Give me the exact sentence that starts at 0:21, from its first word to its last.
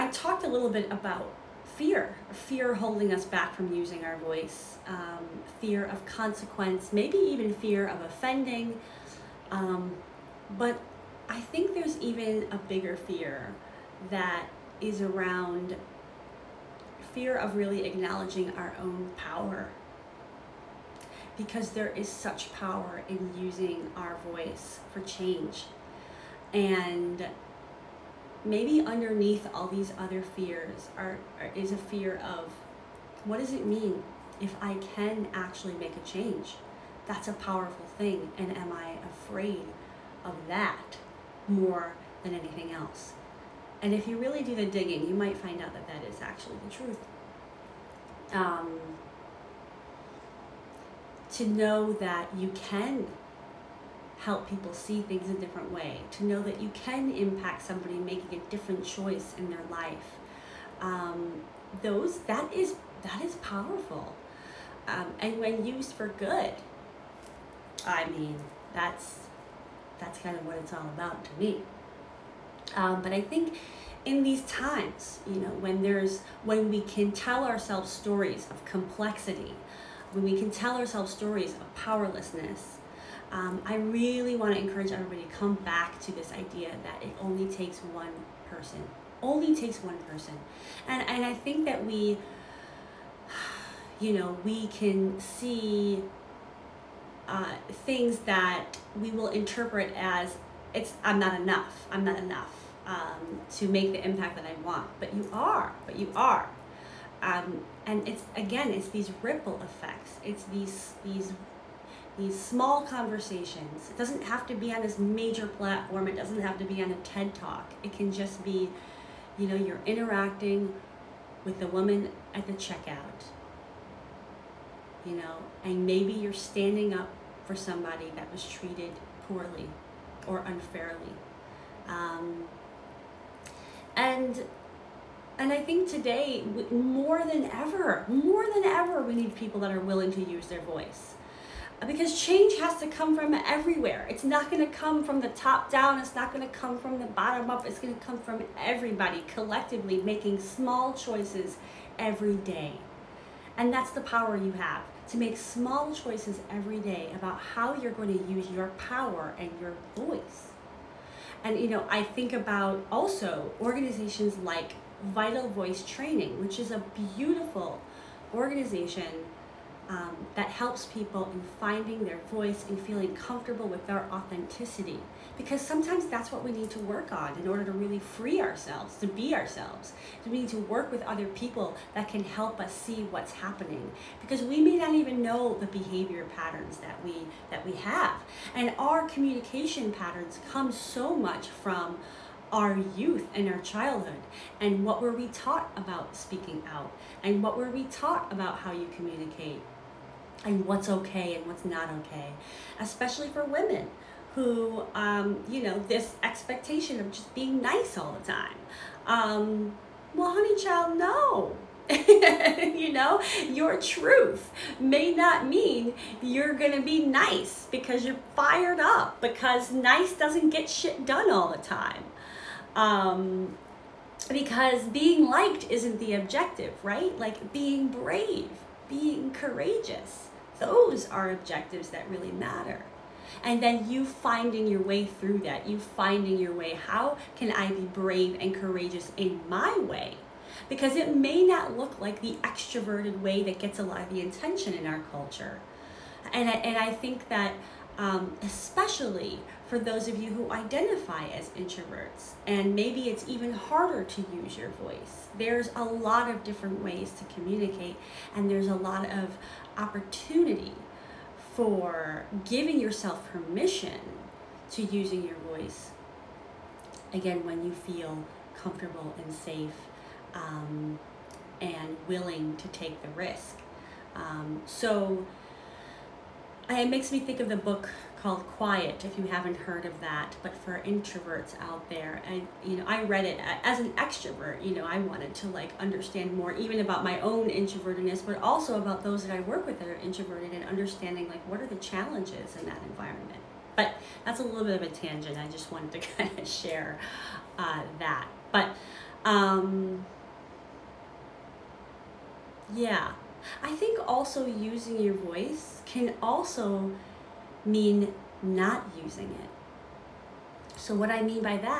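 Because there is such power in using our voice for change.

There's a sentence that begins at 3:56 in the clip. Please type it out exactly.
How can I be brave and courageous in my way?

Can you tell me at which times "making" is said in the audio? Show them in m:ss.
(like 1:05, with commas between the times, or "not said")
0:57, 2:30.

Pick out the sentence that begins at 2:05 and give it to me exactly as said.
You know, and maybe you're standing up for somebody that was treated poorly or unfairly.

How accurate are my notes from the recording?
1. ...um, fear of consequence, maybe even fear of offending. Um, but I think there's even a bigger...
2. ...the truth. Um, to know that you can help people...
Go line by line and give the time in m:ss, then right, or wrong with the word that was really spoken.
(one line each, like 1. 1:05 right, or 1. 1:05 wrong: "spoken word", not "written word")
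1. 0:04 right
2. 0:46 right.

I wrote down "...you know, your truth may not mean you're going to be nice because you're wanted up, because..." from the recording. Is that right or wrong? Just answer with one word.
wrong.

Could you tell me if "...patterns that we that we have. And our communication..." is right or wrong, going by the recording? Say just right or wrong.
right.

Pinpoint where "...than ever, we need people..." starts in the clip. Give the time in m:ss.
2:18.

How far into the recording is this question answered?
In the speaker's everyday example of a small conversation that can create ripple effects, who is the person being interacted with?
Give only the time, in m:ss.
2:01.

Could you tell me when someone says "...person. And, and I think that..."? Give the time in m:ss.
1:29.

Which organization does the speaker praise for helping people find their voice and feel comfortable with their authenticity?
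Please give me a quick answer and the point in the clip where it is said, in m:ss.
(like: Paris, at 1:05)
Vital Voice Training, at 2:45.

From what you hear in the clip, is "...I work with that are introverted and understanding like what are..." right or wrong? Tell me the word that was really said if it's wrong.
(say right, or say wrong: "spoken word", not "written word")
right.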